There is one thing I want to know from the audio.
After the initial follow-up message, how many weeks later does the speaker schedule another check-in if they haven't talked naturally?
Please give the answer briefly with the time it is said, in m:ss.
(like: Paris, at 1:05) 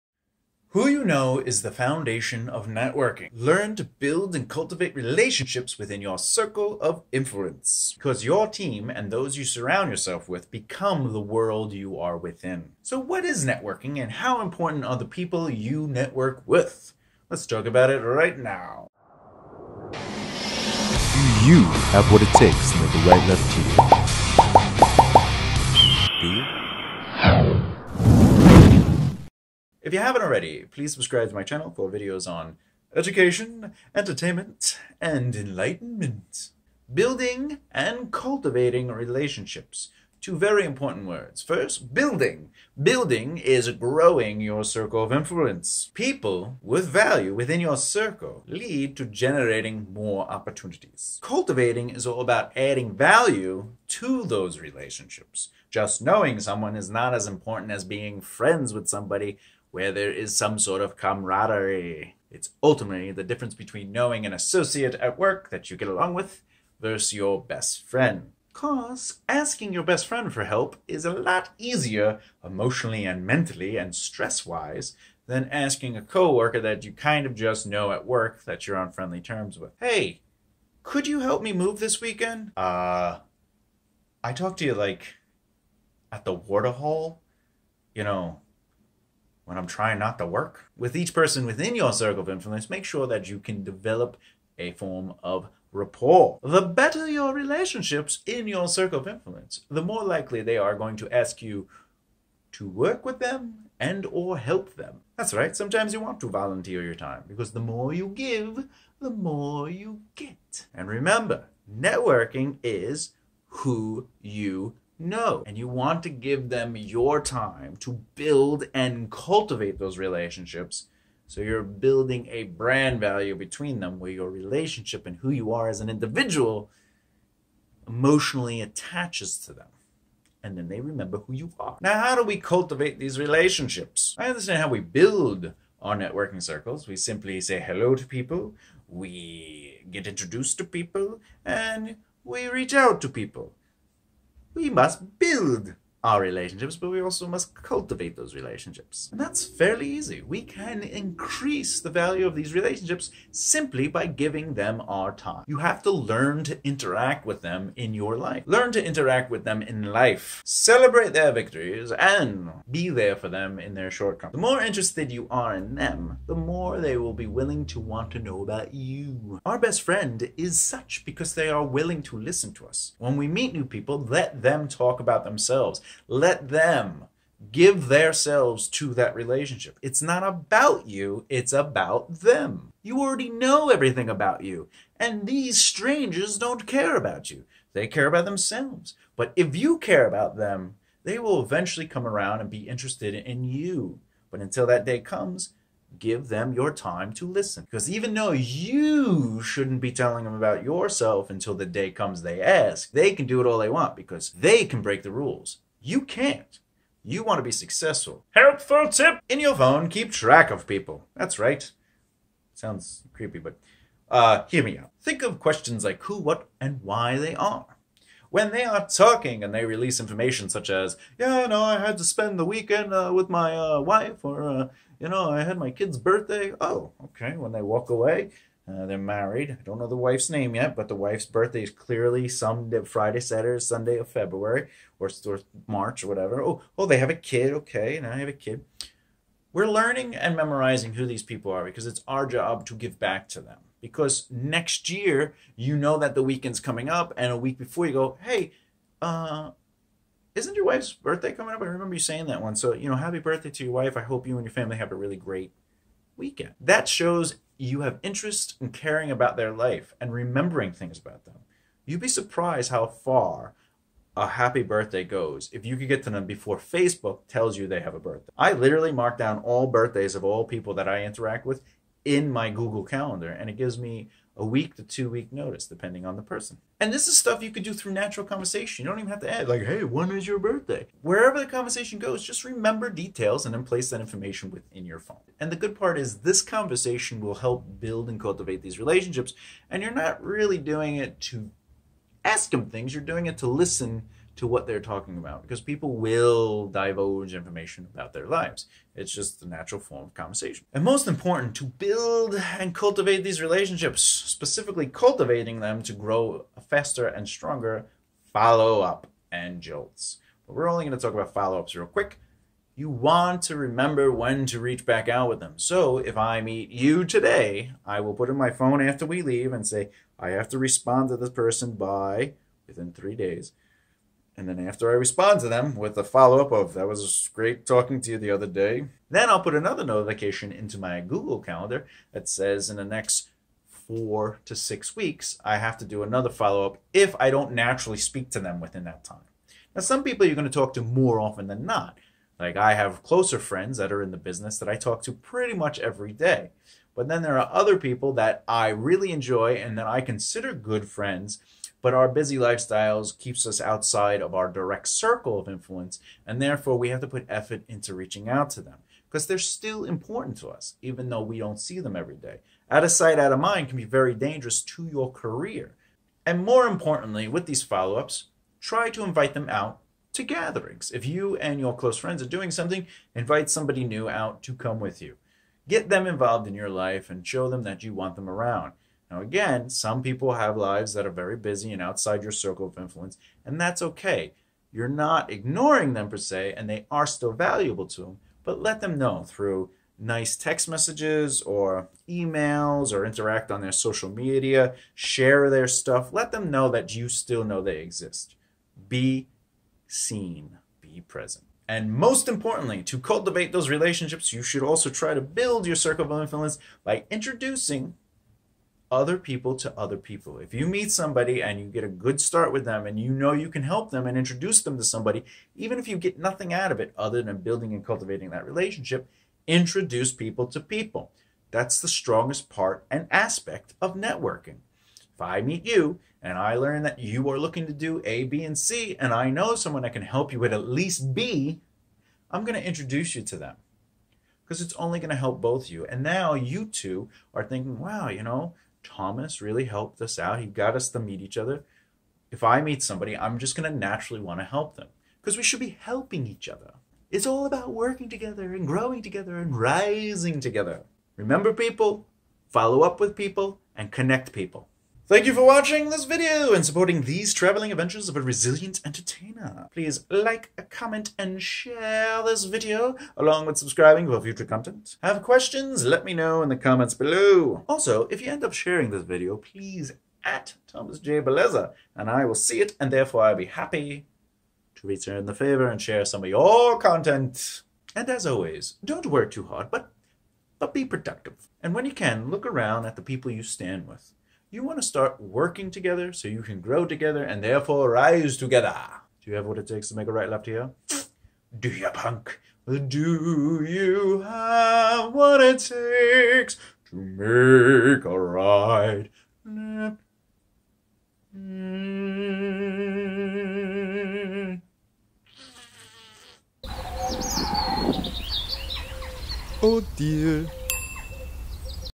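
4 to 6 weeks, at 5:33.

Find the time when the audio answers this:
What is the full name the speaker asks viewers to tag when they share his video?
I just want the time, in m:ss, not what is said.
7:50.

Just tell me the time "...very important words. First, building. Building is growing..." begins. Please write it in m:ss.
0:40.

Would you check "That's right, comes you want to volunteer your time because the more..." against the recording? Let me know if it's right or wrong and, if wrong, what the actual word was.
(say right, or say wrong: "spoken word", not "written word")
wrong: "sometimes", not "comes".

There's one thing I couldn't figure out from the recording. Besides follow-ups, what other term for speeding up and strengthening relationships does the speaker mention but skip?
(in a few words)
jolts.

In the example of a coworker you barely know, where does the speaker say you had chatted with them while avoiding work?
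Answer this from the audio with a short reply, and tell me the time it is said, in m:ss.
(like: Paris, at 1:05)
the water hall, at 1:26.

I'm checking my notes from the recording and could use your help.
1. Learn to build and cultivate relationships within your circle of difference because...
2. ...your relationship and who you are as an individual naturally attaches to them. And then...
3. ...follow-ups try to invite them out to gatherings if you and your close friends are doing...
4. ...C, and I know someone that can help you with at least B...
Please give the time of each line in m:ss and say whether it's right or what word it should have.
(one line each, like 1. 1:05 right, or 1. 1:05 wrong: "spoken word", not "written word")
1. 0:03 wrong: "influence", not "difference"
2. 2:04 wrong: "emotionally", not "naturally"
3. 6:07 right
4. 7:08 right.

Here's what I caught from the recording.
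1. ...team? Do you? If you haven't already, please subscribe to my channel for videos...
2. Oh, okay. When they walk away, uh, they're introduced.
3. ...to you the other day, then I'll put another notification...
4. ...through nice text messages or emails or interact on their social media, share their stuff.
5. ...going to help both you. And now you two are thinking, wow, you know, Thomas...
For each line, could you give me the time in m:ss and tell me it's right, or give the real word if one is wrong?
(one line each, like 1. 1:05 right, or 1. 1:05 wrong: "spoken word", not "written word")
1. 0:26 right
2. 3:46 wrong: "married", not "introduced"
3. 5:28 right
4. 6:29 right
5. 7:14 right.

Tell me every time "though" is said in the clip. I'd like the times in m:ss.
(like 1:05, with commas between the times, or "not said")
3:18, 6:01.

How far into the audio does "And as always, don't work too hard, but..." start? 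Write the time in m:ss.
7:57.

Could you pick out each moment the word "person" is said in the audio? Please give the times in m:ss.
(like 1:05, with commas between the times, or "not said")
1:31, 4:36, 5:21.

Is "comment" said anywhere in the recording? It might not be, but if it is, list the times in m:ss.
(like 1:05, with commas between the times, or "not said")
7:40, 7:46.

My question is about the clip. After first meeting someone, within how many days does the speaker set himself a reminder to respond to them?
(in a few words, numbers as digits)
3 days.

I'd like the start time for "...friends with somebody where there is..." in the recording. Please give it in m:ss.
0:58.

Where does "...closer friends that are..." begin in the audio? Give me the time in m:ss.
5:43.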